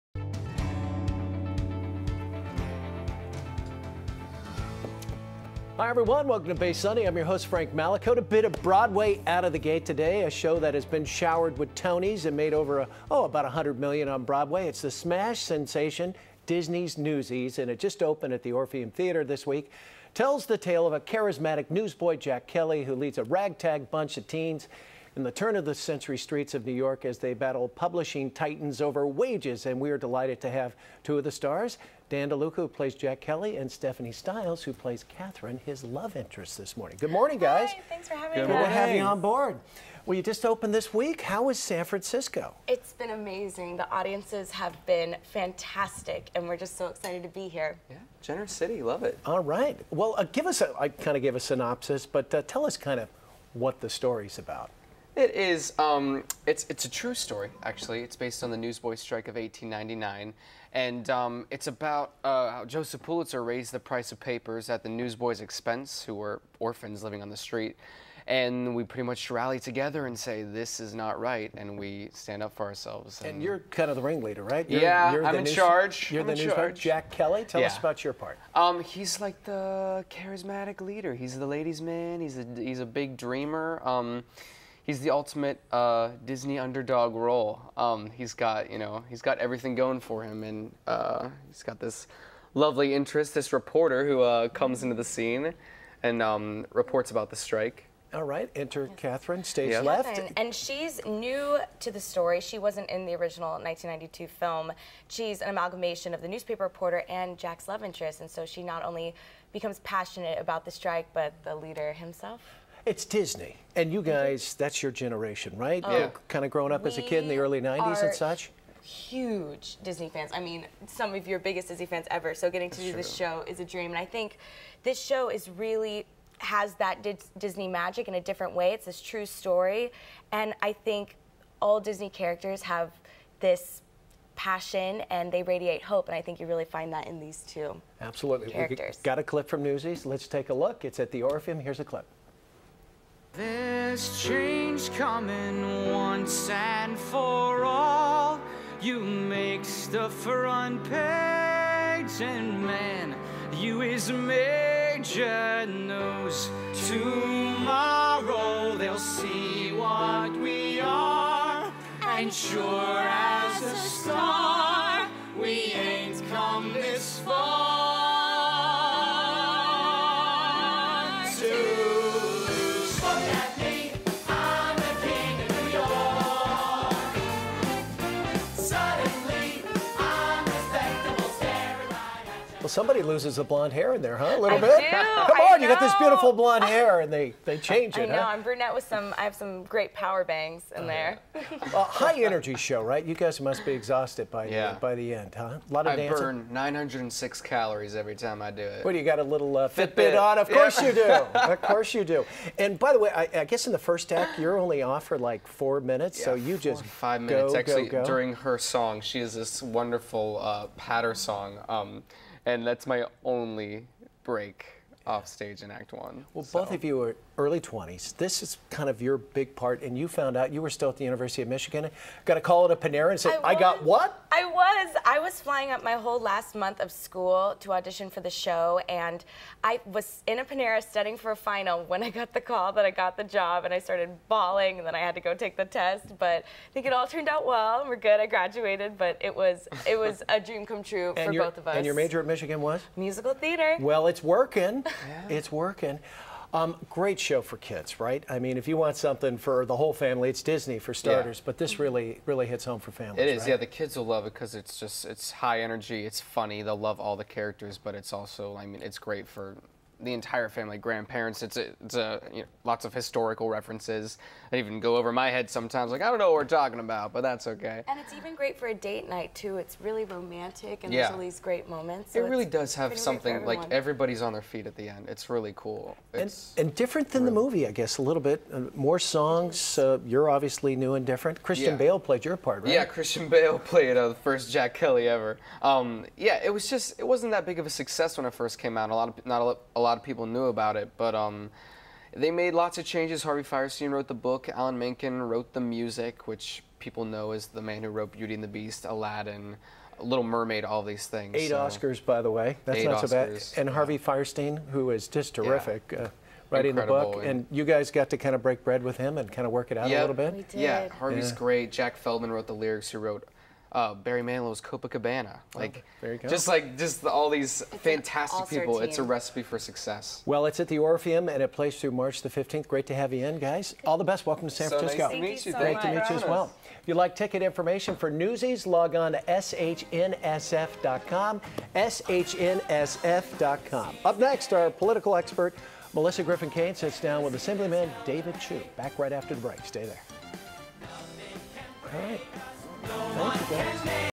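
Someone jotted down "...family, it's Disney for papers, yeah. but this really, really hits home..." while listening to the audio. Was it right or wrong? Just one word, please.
wrong.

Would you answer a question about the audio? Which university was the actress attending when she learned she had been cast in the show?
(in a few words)
University of Michigan.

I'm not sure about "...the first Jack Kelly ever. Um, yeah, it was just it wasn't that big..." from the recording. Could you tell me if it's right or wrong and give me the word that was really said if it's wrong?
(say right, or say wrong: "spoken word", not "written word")
right.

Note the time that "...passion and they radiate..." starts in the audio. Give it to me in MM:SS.
02:14.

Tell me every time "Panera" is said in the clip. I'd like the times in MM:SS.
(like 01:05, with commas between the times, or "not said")
03:42, 03:50.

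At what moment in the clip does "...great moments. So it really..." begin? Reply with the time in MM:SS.
04:31.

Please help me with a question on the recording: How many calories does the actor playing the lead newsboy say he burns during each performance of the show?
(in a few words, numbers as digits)
906.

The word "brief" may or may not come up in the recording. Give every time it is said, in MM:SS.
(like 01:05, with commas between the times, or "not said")
not said.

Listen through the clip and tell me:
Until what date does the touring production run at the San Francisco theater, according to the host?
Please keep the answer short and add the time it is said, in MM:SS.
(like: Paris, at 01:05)
March 15, at 05:21.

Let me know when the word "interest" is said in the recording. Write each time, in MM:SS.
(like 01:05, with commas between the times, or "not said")
00:36, 01:32, 01:47.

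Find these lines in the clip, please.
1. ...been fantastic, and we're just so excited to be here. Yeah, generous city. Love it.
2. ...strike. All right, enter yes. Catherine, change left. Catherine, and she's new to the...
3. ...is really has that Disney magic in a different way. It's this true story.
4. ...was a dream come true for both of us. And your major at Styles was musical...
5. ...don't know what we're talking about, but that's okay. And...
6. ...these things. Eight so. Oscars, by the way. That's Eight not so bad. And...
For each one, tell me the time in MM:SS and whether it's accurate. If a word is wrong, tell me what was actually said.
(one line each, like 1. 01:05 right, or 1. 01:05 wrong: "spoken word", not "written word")
1. 00:44 right
2. 01:37 wrong: "stage", not "change"
3. 02:05 right
4. 03:59 wrong: "Michigan", not "Styles"
5. 04:26 right
6. 05:00 right.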